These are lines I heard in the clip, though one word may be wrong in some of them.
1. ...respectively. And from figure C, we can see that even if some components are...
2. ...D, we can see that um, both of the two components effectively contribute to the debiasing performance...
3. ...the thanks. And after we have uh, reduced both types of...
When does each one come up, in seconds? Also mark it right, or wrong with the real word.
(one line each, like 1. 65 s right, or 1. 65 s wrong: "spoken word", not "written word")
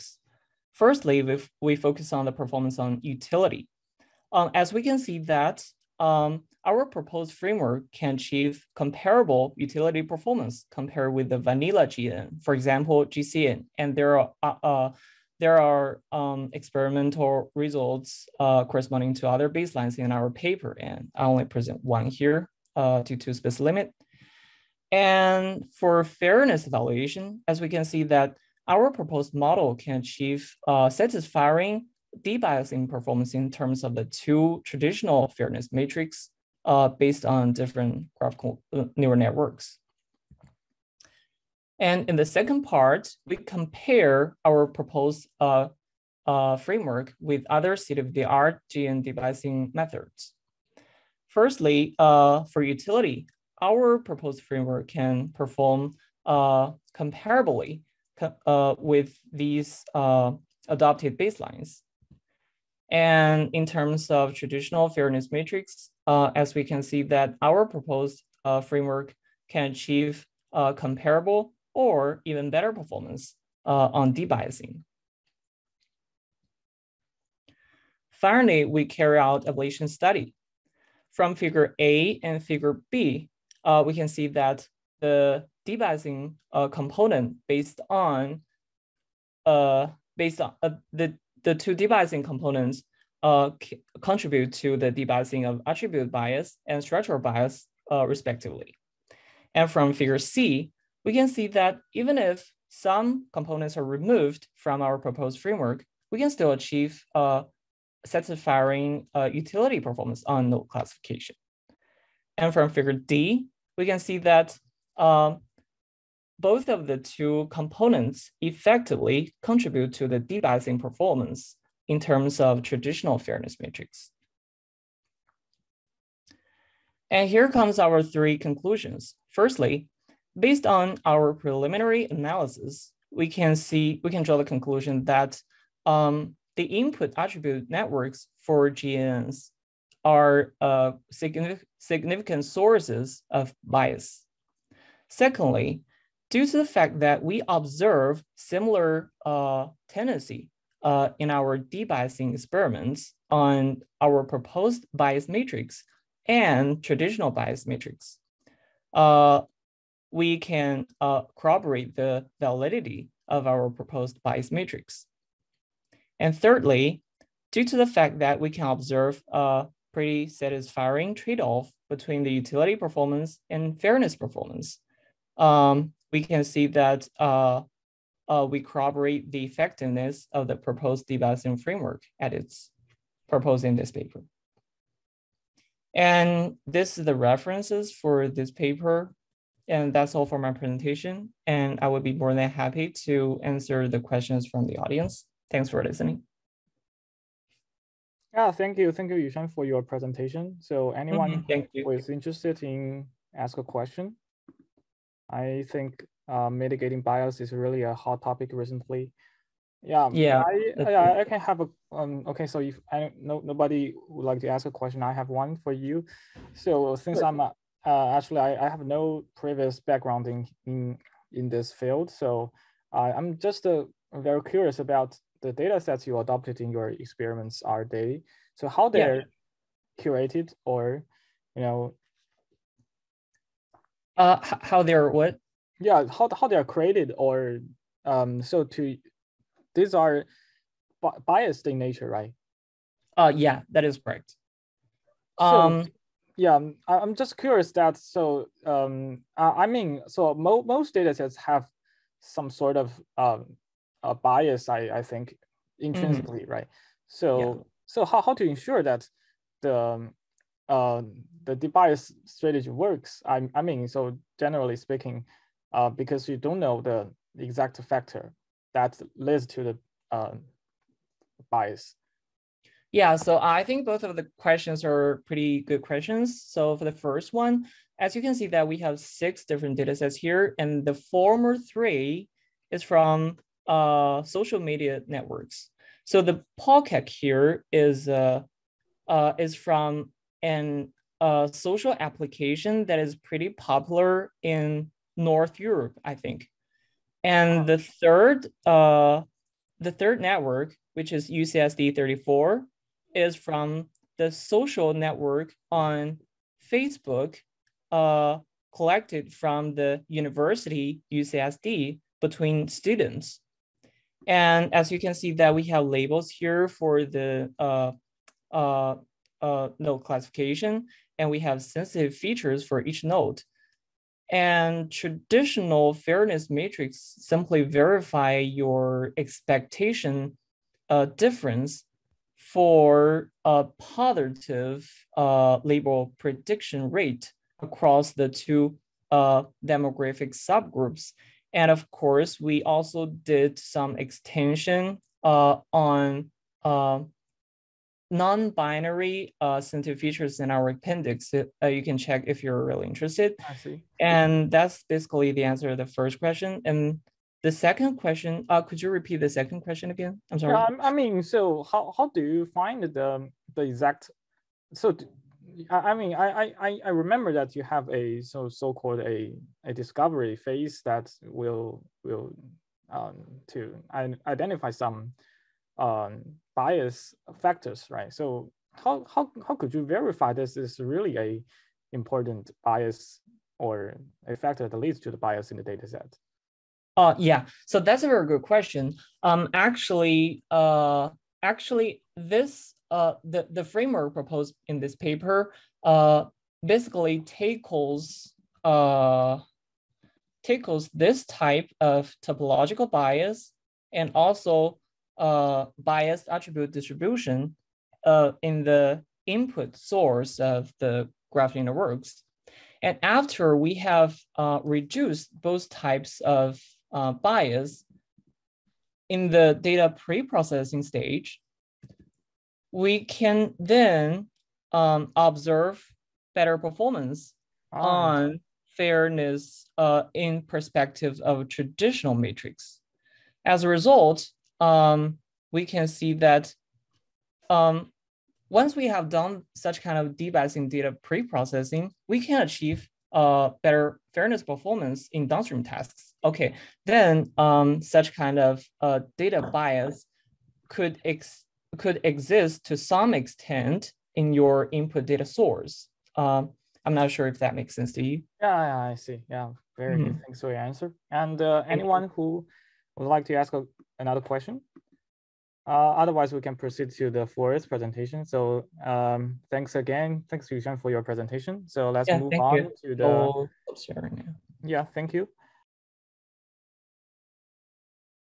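1. 98 s right
2. 112 s right
3. 411 s wrong: "works", not "thanks".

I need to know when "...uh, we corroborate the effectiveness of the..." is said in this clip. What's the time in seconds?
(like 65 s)
178 s.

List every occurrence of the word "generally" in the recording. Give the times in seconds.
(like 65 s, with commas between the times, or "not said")
264 s.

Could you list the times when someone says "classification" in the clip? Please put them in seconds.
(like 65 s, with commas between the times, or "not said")
110 s, 319 s.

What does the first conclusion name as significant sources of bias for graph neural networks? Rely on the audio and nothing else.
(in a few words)
input attribute networks.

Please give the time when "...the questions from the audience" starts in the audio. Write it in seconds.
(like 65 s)
193 s.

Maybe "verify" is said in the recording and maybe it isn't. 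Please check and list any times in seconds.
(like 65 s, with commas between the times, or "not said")
327 s, 379 s.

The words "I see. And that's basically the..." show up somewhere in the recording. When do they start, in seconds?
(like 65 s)
353 s.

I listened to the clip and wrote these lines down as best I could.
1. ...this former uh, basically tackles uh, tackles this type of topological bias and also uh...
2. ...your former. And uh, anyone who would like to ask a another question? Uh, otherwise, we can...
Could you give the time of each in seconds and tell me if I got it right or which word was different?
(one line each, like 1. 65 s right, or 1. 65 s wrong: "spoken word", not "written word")
1. 394 s wrong: "paper", not "former"
2. 460 s wrong: "answer", not "former".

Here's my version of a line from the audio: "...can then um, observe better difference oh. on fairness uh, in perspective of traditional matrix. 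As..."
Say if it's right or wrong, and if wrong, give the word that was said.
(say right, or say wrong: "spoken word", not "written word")
wrong: "performance", not "difference".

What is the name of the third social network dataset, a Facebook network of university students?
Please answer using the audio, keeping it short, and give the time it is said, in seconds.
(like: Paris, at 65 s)
UCSD 34, at 301 s.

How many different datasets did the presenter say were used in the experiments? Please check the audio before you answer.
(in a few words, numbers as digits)
6.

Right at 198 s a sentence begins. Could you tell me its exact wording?
Thank you, Yushun, for your presentation.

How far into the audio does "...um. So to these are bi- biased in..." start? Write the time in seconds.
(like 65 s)
238 s.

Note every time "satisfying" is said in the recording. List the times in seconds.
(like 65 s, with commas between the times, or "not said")
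30 s, 108 s, 170 s.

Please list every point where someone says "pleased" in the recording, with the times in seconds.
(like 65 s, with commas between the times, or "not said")
not said.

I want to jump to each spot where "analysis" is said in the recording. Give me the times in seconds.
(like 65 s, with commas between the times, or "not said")
132 s.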